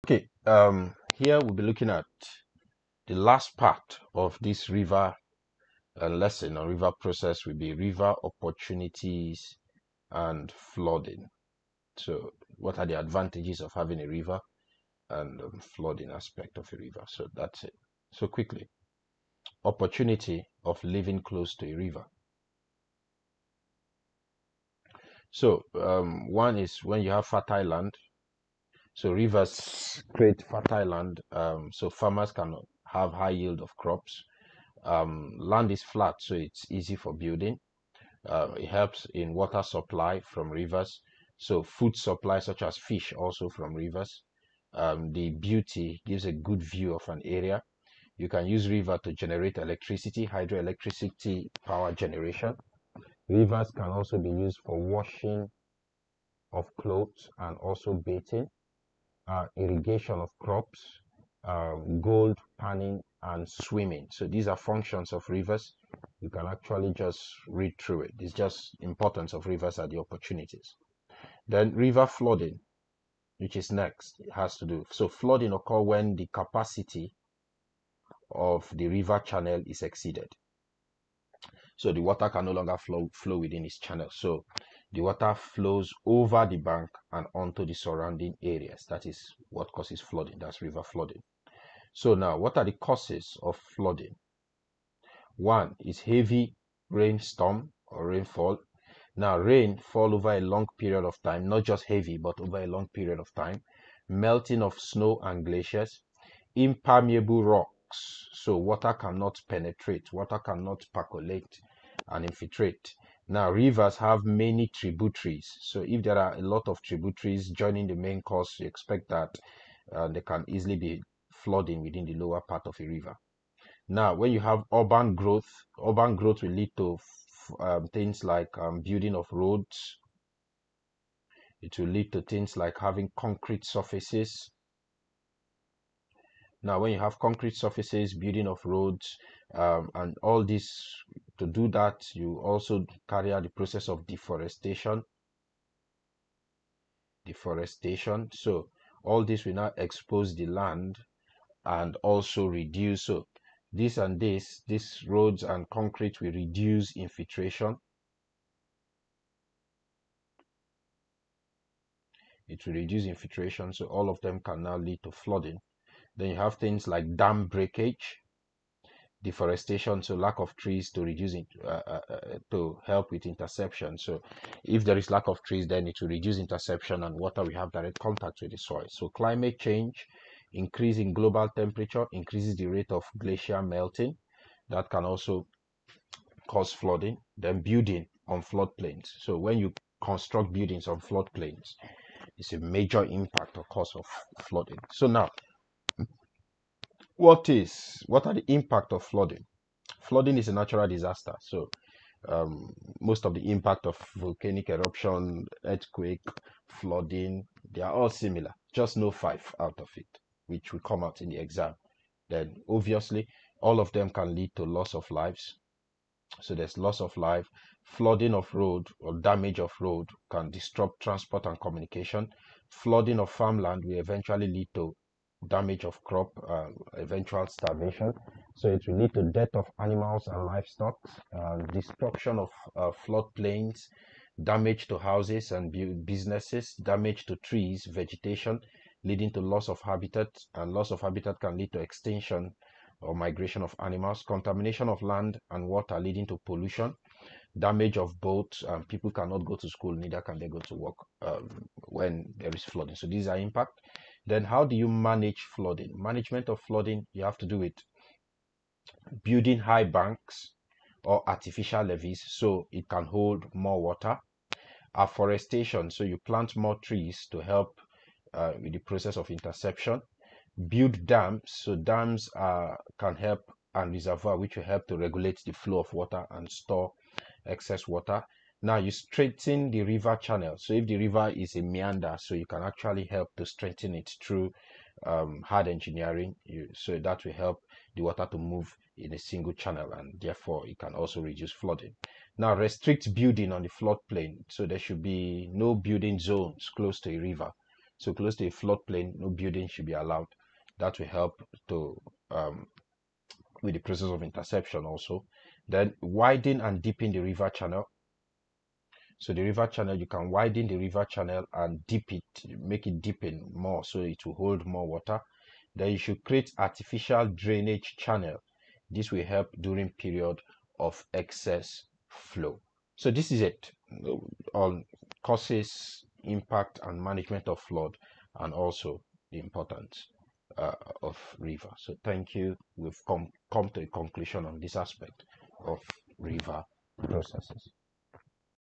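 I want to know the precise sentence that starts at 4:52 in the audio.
Now restrict building on the floodplain.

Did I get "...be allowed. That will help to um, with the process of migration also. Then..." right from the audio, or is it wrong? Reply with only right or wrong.
wrong.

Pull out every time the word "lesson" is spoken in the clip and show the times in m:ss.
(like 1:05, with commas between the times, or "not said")
0:06.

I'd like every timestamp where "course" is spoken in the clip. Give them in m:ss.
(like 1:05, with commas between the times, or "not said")
1:58.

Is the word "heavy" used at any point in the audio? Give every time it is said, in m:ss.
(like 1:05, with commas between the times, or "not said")
1:36, 1:41.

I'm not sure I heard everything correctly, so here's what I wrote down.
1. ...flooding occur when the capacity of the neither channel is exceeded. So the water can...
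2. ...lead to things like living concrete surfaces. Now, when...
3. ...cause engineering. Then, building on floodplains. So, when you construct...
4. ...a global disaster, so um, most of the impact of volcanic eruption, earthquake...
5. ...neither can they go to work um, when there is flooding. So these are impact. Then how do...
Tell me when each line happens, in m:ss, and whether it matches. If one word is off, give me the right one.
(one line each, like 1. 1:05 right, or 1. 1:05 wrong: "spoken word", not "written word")
1. 1:15 wrong: "river", not "neither"
2. 2:11 wrong: "having", not "living"
3. 3:06 wrong: "flooding", not "engineering"
4. 3:20 wrong: "natural", not "global"
5. 4:09 right.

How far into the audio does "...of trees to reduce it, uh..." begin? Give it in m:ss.
2:50.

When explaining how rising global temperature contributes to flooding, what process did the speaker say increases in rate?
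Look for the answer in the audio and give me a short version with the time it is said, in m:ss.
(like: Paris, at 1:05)
Glacier melting, at 3:03.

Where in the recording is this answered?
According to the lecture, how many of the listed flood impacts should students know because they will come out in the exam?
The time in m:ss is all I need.
3:29.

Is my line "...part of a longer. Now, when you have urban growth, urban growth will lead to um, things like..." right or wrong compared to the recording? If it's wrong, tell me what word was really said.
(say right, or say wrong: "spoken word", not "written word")
wrong: "river", not "longer".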